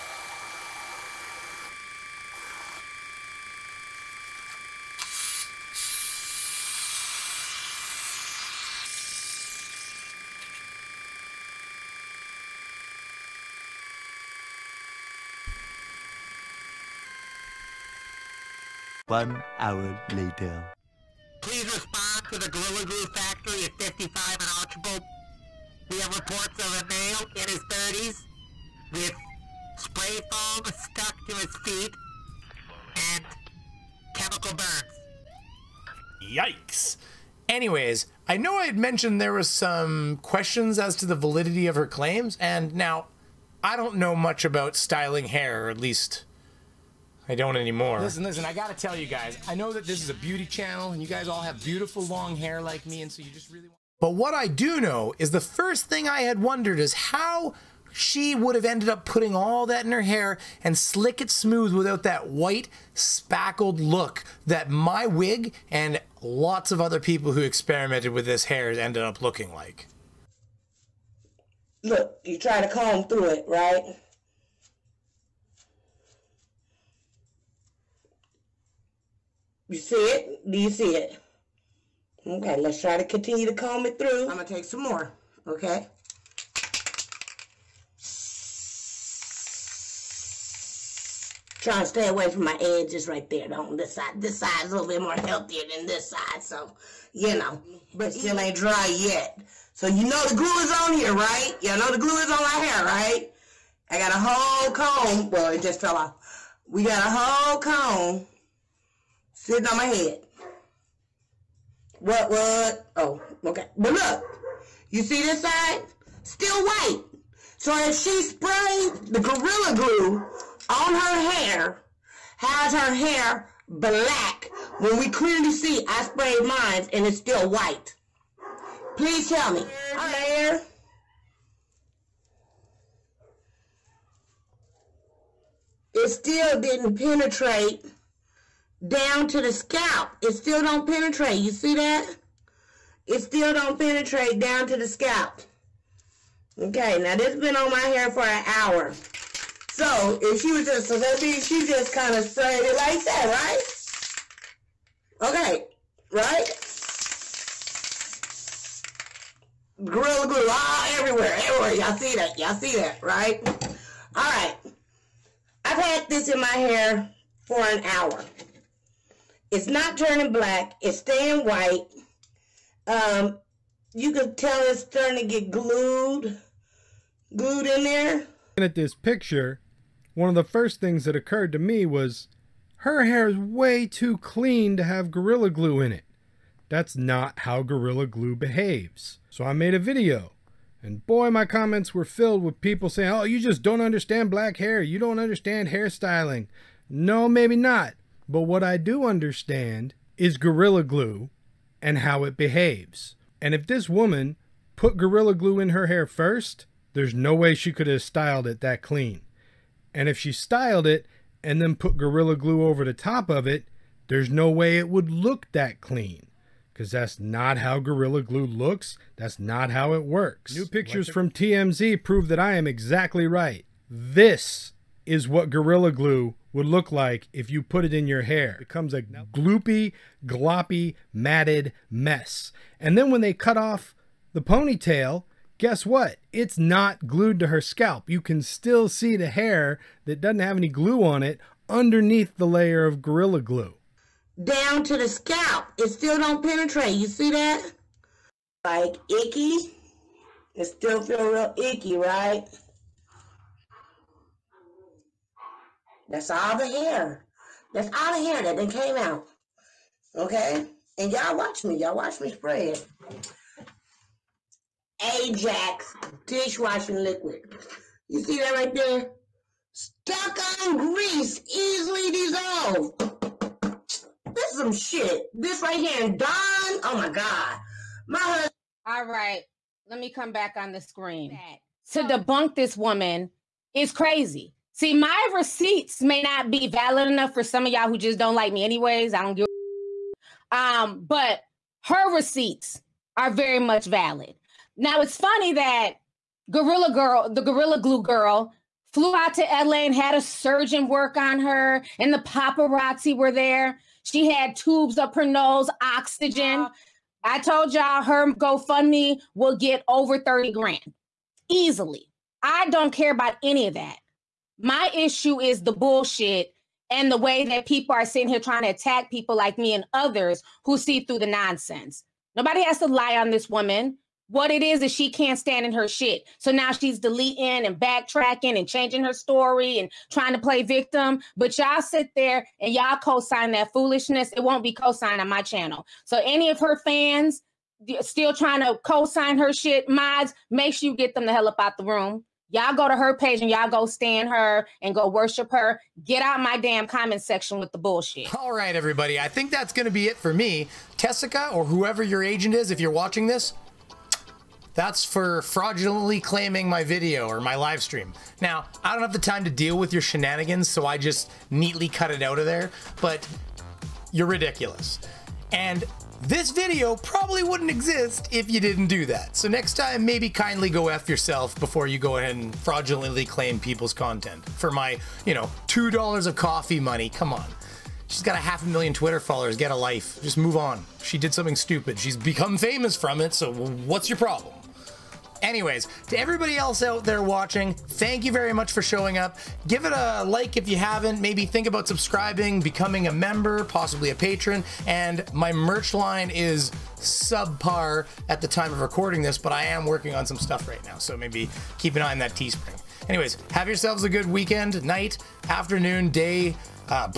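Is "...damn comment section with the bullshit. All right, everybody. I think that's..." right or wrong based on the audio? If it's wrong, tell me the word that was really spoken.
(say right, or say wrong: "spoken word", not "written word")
right.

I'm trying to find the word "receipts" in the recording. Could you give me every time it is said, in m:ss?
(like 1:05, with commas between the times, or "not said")
4:45, 4:52.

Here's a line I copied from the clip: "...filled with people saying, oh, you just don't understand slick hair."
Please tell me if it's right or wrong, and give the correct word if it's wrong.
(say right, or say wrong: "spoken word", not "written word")
wrong: "black", not "slick".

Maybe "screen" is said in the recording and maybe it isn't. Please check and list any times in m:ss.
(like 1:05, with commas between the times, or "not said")
4:40.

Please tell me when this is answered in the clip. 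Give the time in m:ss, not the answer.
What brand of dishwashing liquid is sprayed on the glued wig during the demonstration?
4:25.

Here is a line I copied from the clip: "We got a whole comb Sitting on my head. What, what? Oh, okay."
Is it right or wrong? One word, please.
right.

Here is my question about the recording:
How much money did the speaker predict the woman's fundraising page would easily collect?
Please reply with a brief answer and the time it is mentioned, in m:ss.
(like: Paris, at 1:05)
30 grand, at 5:10.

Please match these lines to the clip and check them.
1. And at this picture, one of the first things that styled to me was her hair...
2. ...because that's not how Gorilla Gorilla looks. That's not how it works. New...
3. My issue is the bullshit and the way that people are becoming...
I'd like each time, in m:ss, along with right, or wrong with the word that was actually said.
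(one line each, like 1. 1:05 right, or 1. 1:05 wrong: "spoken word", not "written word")
1. 2:58 wrong: "occurred", not "styled"
2. 3:36 wrong: "Glue", not "Gorilla"
3. 5:14 wrong: "sitting", not "becoming".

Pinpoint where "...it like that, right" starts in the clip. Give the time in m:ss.
2:32.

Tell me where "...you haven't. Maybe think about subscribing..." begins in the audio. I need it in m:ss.
6:30.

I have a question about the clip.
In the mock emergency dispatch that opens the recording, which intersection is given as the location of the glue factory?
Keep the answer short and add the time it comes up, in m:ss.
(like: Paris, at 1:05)
55 and Archibald, at 0:23.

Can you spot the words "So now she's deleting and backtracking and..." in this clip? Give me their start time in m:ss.
5:26.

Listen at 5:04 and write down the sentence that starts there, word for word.
She had tubes up her nose, oxygen.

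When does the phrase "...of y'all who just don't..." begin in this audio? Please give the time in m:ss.
4:47.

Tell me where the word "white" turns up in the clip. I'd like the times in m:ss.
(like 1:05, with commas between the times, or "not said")
1:02, 1:56, 2:07, 2:51.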